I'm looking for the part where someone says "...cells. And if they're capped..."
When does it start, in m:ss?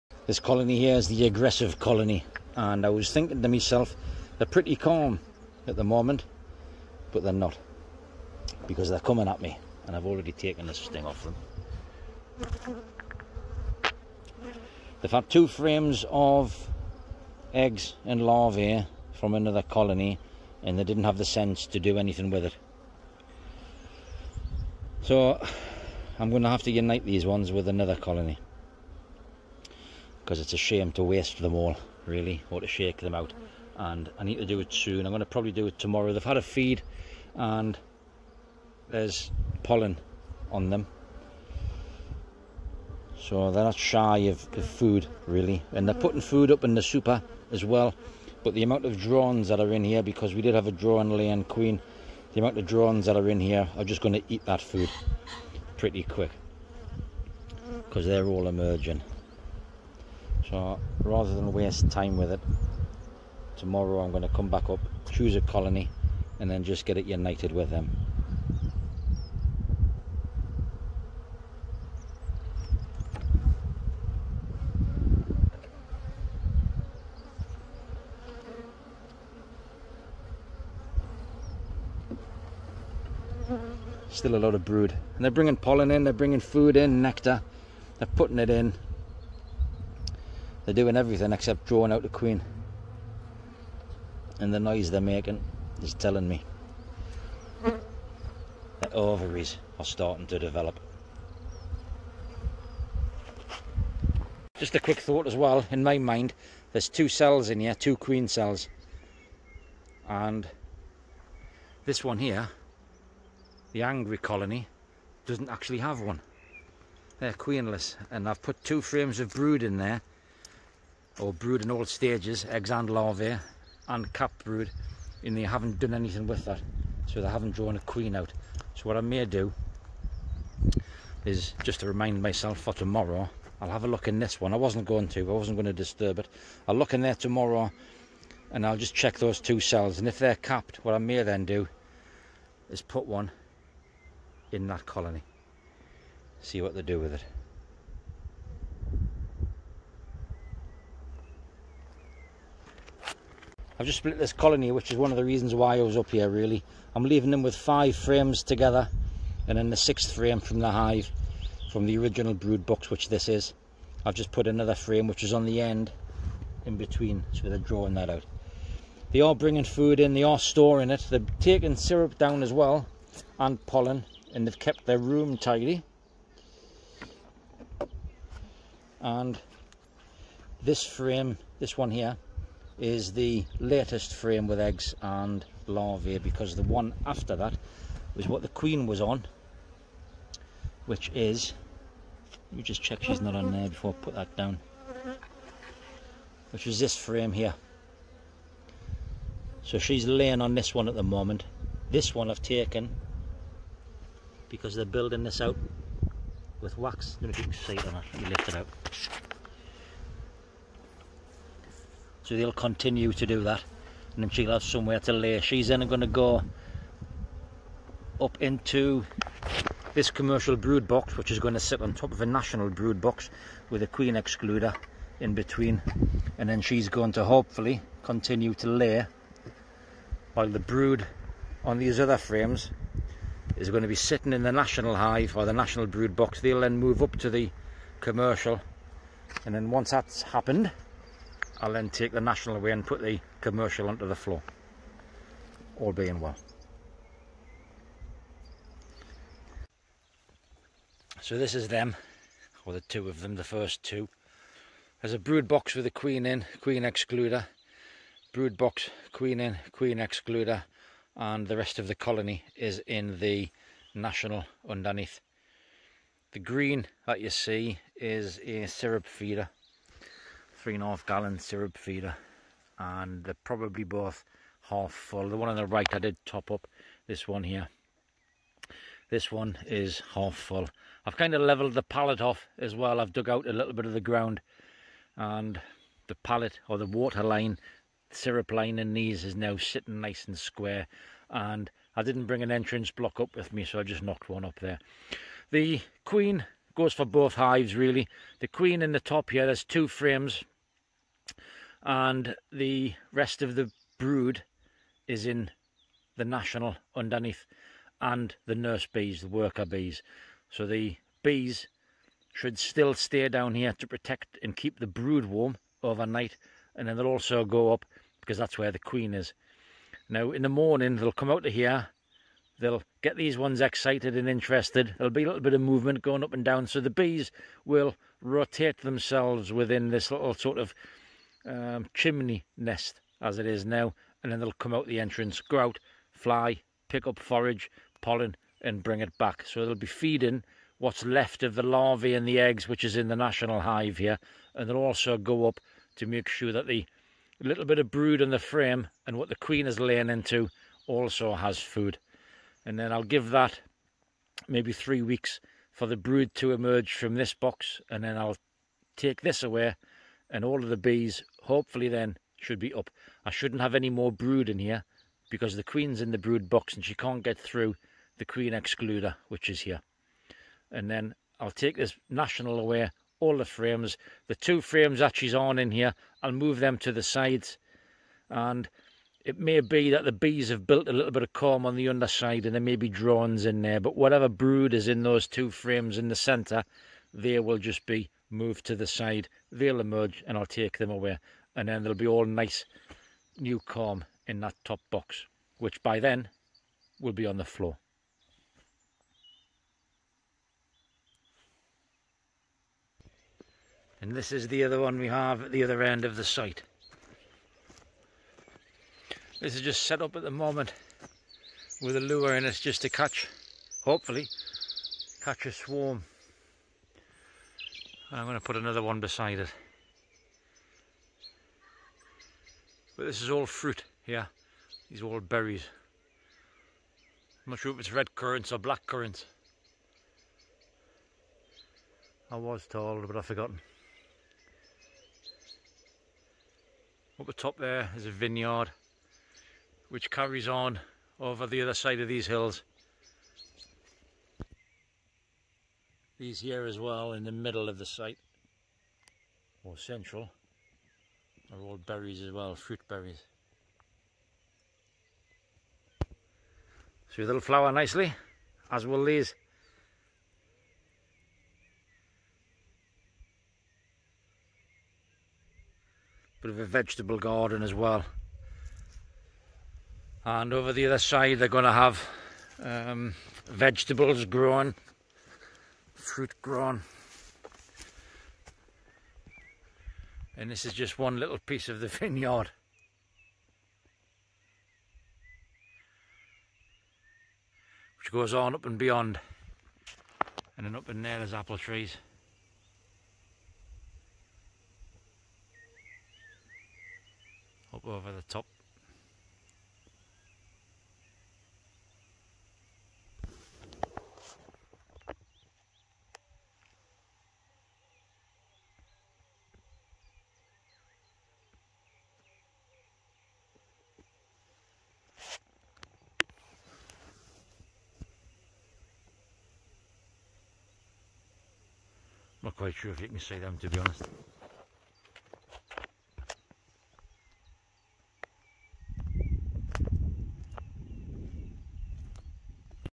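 2:19.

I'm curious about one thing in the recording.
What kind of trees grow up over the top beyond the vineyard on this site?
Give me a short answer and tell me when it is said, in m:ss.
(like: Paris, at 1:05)
apple trees, at 8:11.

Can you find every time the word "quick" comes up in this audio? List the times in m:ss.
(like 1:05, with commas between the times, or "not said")
0:56, 1:44.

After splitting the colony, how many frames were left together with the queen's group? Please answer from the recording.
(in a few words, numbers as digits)
5.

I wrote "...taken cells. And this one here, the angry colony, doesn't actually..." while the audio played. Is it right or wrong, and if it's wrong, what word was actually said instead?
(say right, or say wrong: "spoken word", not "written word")
wrong: "queen", not "taken".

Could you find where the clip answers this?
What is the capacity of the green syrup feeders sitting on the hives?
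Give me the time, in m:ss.
4:30.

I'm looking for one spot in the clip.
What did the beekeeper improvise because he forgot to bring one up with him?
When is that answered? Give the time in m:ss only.
4:52.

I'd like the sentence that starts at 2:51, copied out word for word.
They're taking syrup down as well, and pollen, and they've kept their room tidy.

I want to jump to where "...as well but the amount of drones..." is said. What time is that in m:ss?
0:47.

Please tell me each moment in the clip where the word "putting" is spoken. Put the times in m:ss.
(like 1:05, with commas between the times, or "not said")
0:45, 1:28.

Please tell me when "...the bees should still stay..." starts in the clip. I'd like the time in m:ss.
5:10.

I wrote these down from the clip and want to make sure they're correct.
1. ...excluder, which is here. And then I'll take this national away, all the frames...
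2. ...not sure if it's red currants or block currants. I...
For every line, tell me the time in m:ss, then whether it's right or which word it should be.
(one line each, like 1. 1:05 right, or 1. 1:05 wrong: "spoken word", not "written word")
1. 6:08 right
2. 7:07 wrong: "black", not "block".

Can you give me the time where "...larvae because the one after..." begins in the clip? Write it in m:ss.
3:05.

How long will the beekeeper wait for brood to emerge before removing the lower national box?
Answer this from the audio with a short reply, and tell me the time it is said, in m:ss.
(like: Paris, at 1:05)
3 weeks, at 5:54.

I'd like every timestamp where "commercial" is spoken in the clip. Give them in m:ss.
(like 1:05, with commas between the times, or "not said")
3:40, 3:57, 4:03.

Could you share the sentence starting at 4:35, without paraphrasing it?
The one on the right I did top up, this one here.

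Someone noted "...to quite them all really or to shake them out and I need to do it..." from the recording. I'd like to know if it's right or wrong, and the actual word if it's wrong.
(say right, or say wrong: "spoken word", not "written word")
wrong: "waste", not "quite".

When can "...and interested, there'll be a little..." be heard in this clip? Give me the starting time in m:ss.
5:24.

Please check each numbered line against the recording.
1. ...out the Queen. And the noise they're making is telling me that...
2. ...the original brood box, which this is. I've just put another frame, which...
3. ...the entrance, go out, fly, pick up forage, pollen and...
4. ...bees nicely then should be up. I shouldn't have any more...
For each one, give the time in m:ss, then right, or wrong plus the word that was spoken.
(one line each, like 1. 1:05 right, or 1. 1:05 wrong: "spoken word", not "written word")
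1. 1:31 right
2. 2:41 right
3. 5:34 right
4. 6:00 wrong: "hopefully", not "nicely".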